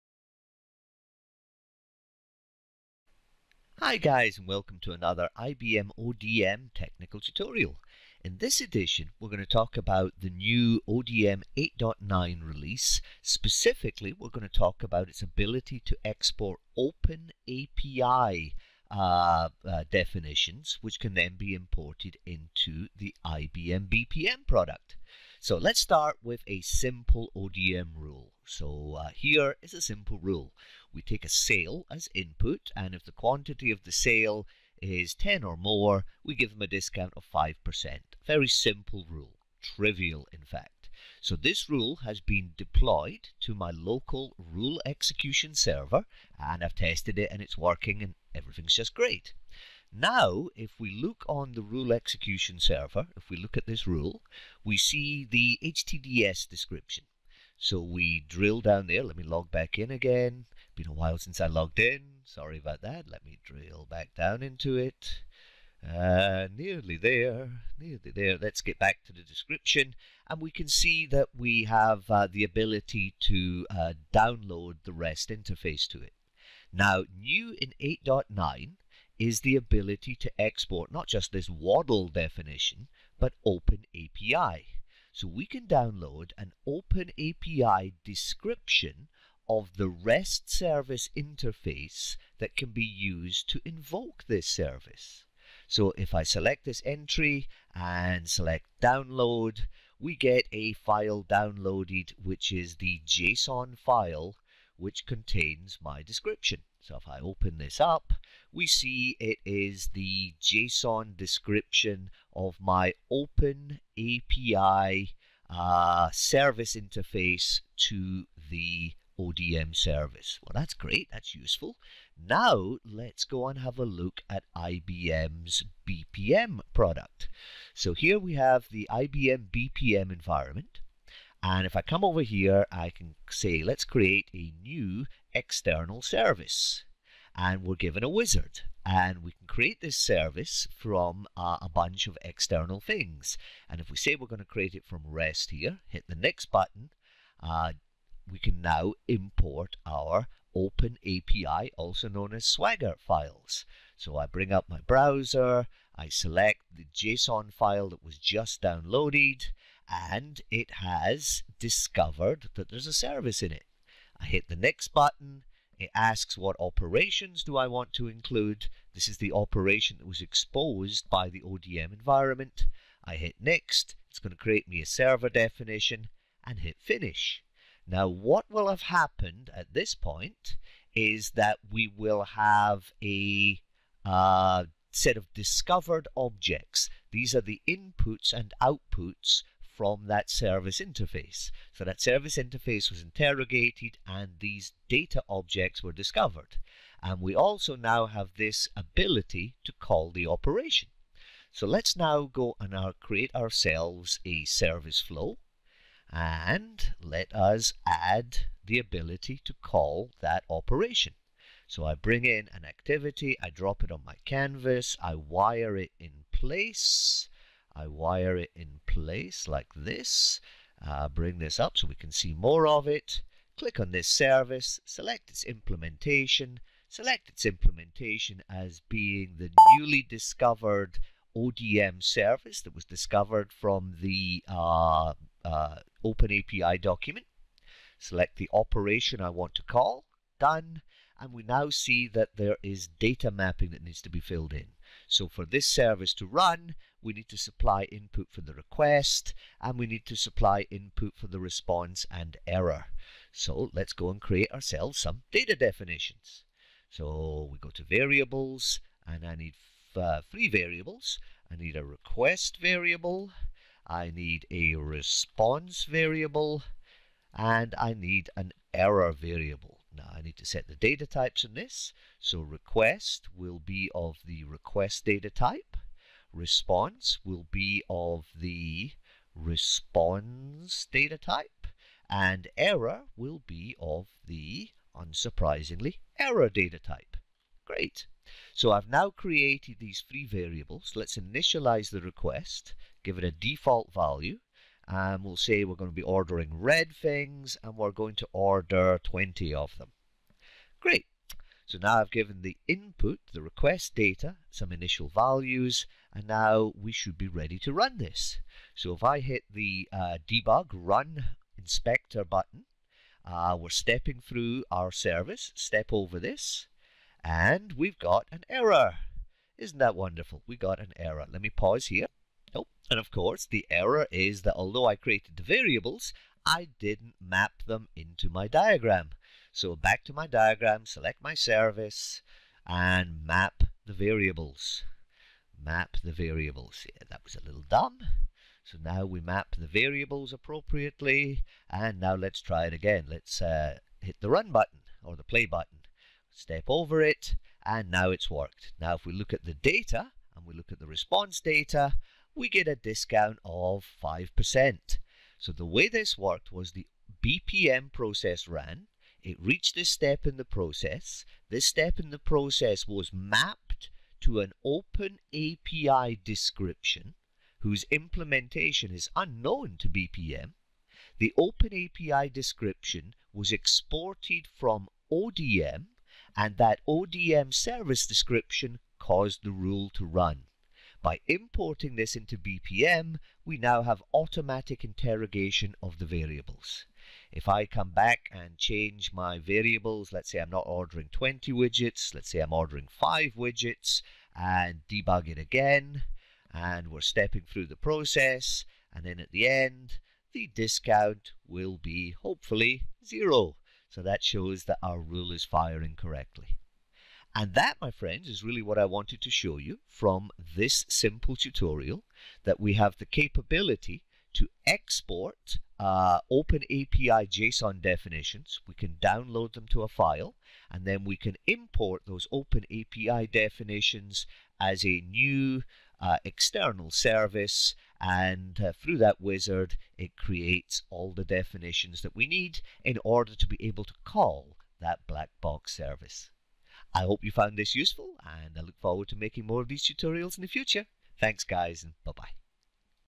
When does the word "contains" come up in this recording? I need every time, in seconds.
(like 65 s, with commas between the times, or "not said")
105 s.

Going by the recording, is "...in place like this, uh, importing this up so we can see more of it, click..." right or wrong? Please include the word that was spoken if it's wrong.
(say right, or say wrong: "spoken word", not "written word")
wrong: "bring", not "importing".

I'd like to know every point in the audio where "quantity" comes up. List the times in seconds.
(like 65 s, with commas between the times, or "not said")
33 s.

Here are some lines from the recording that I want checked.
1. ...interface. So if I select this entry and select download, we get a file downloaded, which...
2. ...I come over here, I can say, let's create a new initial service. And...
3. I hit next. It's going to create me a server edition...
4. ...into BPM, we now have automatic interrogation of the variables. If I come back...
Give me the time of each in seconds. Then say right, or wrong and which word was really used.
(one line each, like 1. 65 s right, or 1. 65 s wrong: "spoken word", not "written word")
1. 94 s wrong: "service", not "interface"
2. 131 s wrong: "external", not "initial"
3. 173 s wrong: "definition", not "edition"
4. 382 s right.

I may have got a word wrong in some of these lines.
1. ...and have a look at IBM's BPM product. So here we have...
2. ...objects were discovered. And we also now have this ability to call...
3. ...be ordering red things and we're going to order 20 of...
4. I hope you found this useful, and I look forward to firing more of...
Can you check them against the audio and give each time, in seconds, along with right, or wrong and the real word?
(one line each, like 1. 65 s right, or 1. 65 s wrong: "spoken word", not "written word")
1. 123 s right
2. 195 s right
3. 295 s right
4. 436 s wrong: "making", not "firing".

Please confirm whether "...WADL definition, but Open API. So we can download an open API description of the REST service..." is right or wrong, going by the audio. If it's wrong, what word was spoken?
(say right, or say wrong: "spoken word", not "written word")
right.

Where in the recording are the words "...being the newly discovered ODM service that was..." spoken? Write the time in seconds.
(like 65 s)
228 s.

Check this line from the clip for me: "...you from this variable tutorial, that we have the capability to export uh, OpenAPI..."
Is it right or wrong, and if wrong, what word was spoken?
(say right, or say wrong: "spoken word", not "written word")
wrong: "simple", not "variable".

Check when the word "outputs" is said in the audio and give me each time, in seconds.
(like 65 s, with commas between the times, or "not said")
188 s.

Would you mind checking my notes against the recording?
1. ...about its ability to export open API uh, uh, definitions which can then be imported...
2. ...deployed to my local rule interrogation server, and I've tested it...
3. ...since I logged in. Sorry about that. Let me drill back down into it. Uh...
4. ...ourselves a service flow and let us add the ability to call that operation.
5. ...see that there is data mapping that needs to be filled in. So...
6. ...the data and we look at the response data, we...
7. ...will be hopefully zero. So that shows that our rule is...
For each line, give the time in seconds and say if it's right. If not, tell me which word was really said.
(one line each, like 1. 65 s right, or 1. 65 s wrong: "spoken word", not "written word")
1. 14 s right
2. 42 s wrong: "execution", not "interrogation"
3. 61 s right
4. 203 s right
5. 241 s right
6. 349 s right
7. 401 s right.